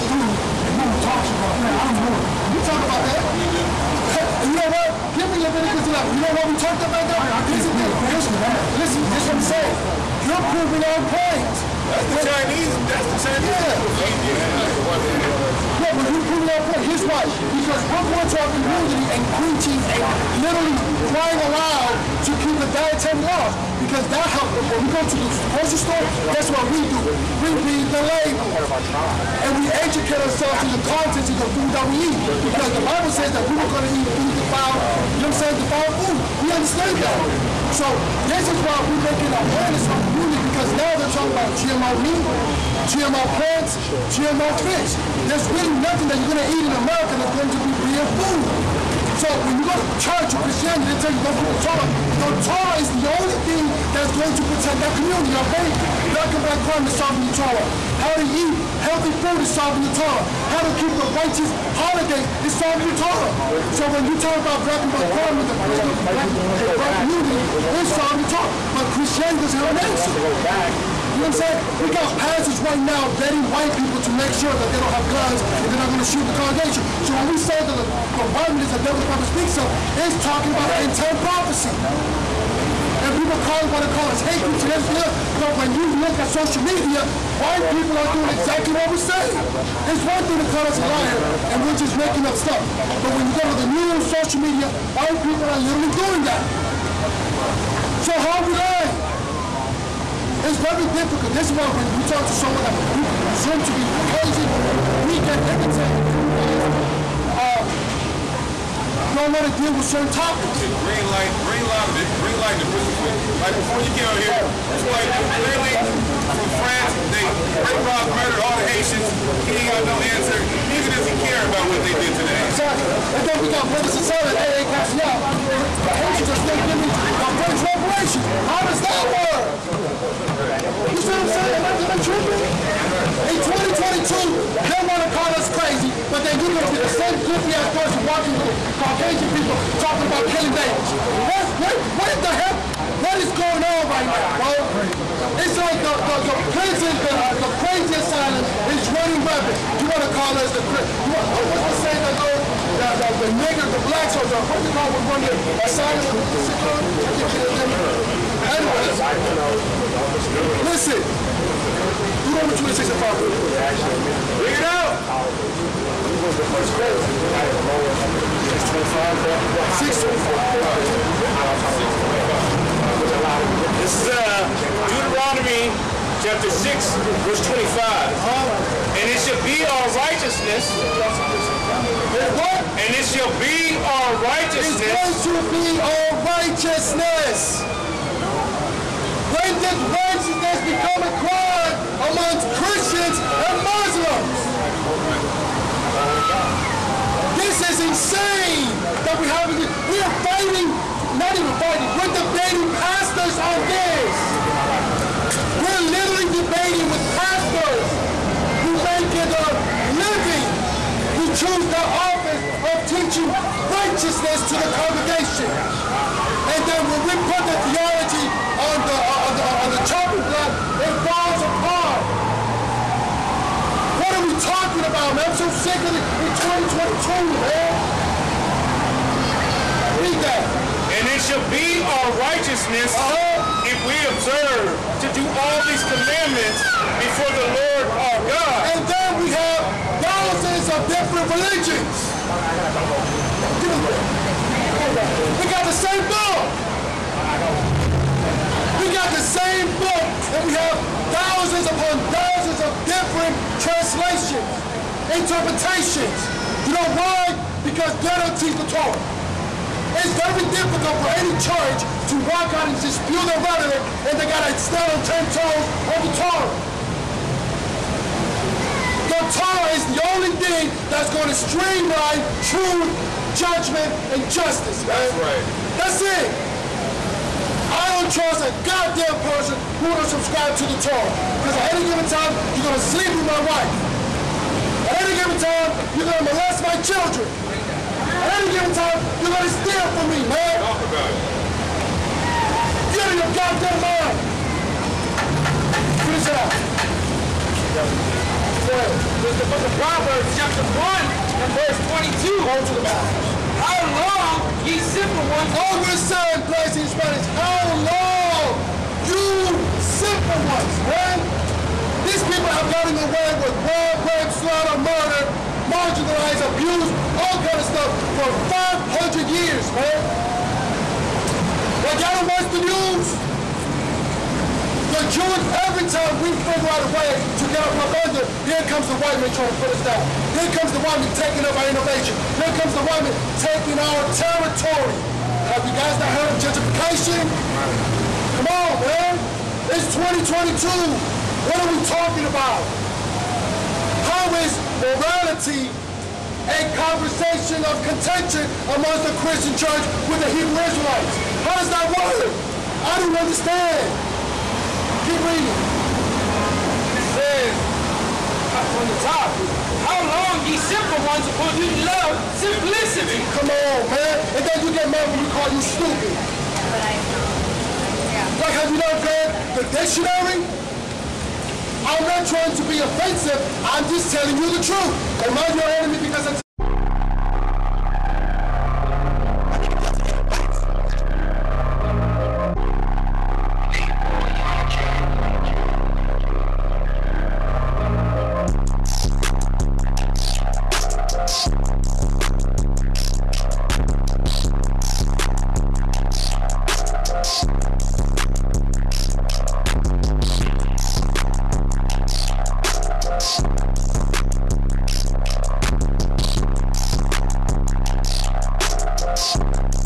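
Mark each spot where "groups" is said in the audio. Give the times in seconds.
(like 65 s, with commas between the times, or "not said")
84 s.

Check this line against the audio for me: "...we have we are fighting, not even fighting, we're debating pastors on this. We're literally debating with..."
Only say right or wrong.
right.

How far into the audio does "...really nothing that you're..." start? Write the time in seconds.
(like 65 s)
45 s.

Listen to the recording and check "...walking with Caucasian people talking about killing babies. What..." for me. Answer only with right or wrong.
right.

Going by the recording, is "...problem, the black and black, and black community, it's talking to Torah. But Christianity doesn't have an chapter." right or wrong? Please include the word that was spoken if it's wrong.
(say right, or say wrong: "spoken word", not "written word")
wrong: "answer", not "chapter".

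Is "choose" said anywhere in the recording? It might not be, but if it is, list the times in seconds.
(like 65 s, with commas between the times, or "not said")
211 s.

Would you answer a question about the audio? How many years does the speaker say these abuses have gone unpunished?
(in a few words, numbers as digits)
500 years.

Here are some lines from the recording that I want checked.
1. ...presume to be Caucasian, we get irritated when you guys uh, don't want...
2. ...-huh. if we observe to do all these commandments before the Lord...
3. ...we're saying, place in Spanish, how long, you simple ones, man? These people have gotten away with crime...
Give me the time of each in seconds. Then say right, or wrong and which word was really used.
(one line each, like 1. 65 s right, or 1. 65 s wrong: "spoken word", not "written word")
1. 103 s right
2. 233 s right
3. 305 s right.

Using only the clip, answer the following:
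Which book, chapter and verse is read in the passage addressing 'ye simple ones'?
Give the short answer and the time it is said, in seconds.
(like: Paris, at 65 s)
Proverbs 1:22, at 299 s.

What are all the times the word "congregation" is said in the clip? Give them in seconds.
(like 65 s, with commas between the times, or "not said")
76 s, 214 s.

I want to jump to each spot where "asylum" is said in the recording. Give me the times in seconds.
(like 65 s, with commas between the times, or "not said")
147 s, 155 s.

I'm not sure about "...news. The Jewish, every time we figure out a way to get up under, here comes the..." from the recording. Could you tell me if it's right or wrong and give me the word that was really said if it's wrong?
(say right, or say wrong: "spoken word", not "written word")
right.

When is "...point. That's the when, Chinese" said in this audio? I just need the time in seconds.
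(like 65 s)
11 s.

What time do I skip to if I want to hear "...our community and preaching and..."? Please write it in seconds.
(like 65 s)
18 s.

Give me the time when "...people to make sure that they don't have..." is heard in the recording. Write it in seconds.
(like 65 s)
73 s.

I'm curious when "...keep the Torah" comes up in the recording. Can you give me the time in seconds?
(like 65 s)
51 s.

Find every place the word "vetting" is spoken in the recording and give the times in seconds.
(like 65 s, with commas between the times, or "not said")
73 s.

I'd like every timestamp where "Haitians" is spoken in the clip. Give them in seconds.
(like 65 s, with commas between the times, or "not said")
118 s, 125 s.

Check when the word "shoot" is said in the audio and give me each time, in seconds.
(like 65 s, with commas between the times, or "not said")
76 s.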